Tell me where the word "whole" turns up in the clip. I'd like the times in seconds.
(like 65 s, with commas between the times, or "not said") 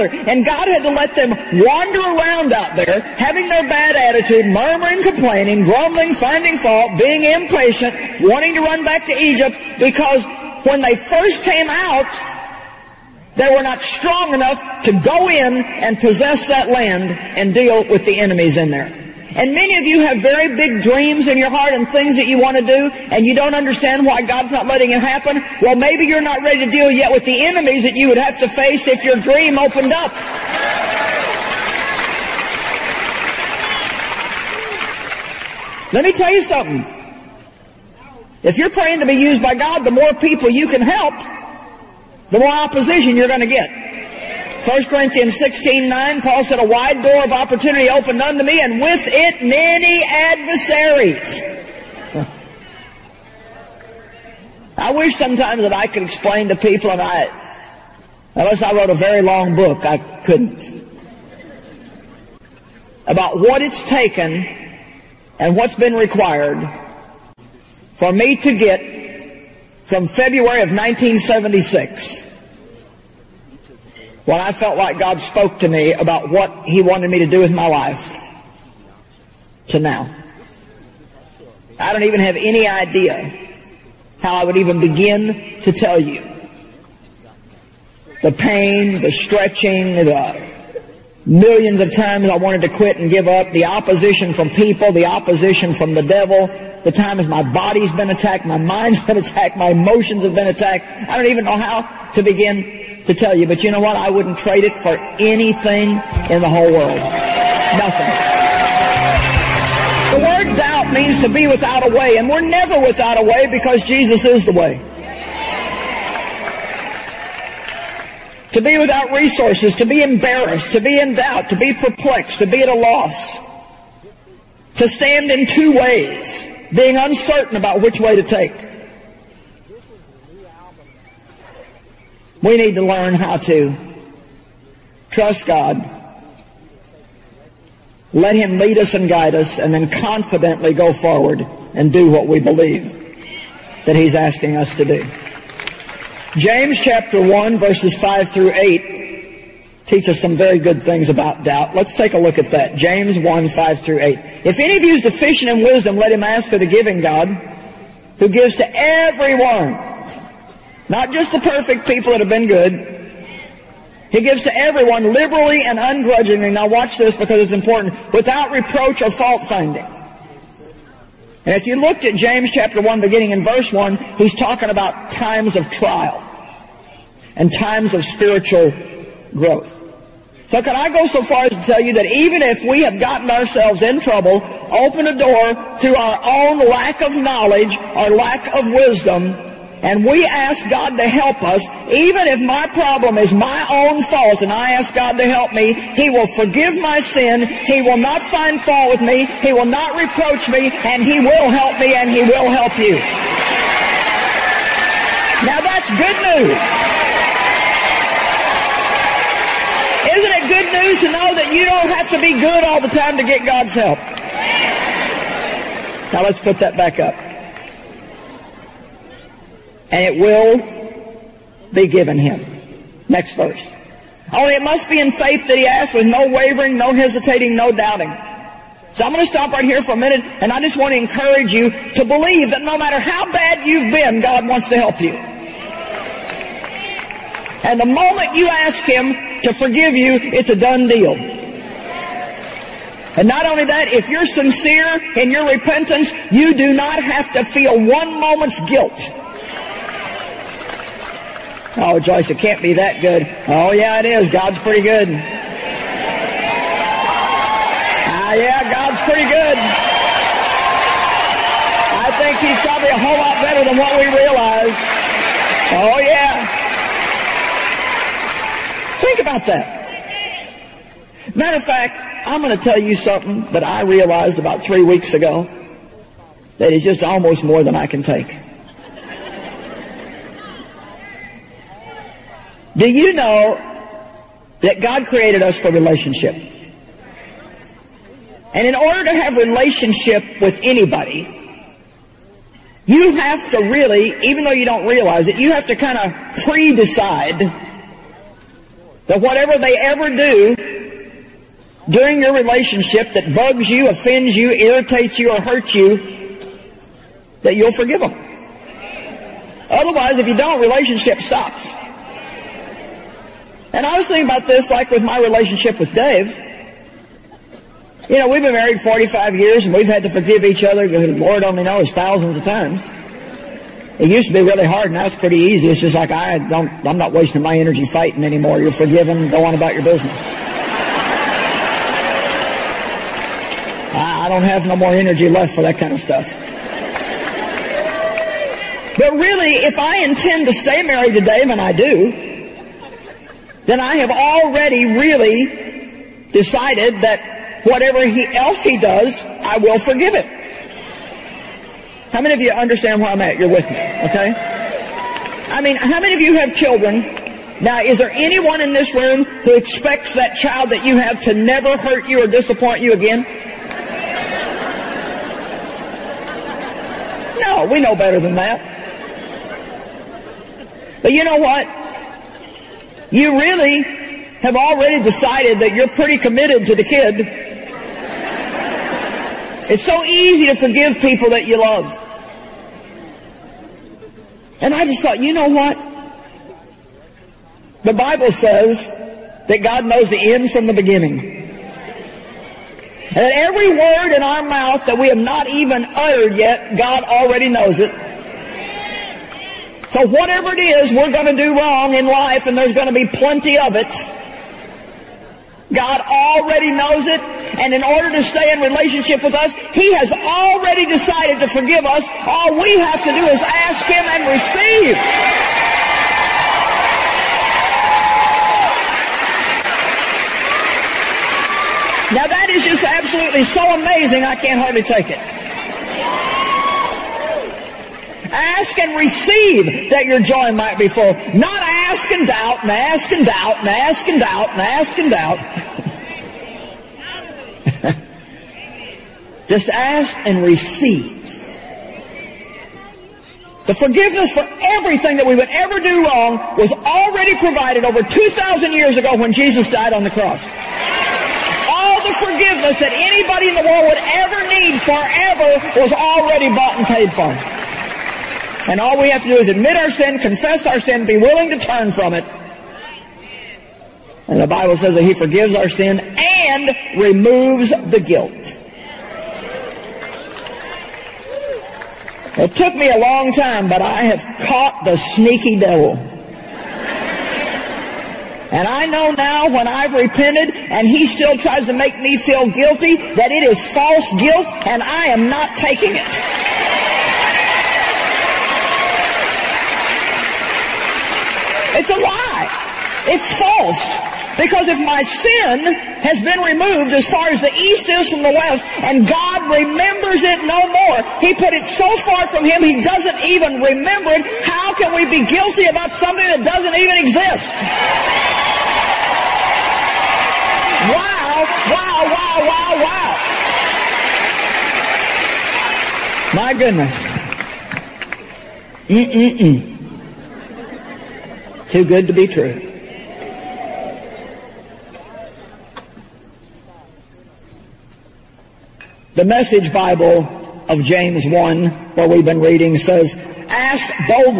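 106 s, 263 s.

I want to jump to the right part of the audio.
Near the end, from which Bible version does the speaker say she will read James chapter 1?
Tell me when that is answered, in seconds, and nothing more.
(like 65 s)
529 s.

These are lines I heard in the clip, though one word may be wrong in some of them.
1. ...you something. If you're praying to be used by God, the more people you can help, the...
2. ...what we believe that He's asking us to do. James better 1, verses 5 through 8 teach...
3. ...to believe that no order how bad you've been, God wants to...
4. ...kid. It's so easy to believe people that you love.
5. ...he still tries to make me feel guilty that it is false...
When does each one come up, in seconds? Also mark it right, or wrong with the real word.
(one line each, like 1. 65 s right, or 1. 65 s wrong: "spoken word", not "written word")
1. 36 s right
2. 142 s wrong: "chapter", not "better"
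3. 231 s wrong: "matter", not "order"
4. 376 s wrong: "forgive", not "believe"
5. 480 s right.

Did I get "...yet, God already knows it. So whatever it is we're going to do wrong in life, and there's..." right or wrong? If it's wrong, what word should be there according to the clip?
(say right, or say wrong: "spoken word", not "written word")
right.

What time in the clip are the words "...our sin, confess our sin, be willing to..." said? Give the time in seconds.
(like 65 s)
459 s.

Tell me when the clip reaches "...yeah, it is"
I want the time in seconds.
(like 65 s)
253 s.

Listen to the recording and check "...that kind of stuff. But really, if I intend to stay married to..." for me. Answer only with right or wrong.
right.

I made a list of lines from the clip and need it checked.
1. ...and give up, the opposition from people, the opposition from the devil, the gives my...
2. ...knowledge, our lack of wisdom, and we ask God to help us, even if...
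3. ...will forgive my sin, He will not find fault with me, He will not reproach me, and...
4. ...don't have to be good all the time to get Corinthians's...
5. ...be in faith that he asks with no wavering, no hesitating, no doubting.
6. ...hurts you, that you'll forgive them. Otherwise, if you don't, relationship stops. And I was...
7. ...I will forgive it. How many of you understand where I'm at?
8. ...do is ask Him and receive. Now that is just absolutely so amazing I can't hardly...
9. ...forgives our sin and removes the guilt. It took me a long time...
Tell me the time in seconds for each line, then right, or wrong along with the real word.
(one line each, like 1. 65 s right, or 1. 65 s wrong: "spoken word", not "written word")
1. 92 s wrong: "times", not "gives"
2. 187 s right
3. 196 s right
4. 211 s wrong: "God", not "Corinthians"
5. 224 s right
6. 305 s right
7. 349 s right
8. 413 s right
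9. 465 s right.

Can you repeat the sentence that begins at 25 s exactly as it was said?
Well, maybe you're not ready to deal yet with the enemies that you would have to face if your dream opened up.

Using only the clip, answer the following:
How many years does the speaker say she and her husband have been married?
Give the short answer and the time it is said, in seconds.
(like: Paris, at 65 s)
45, at 318 s.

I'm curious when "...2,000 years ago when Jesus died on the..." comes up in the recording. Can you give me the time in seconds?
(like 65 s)
448 s.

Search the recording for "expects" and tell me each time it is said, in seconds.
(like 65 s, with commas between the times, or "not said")
359 s.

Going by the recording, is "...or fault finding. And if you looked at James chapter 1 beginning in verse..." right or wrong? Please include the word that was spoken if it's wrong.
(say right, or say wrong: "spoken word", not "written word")
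right.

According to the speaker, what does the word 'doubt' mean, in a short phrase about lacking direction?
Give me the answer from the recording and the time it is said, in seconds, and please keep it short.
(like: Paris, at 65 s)
to be without a way, at 111 s.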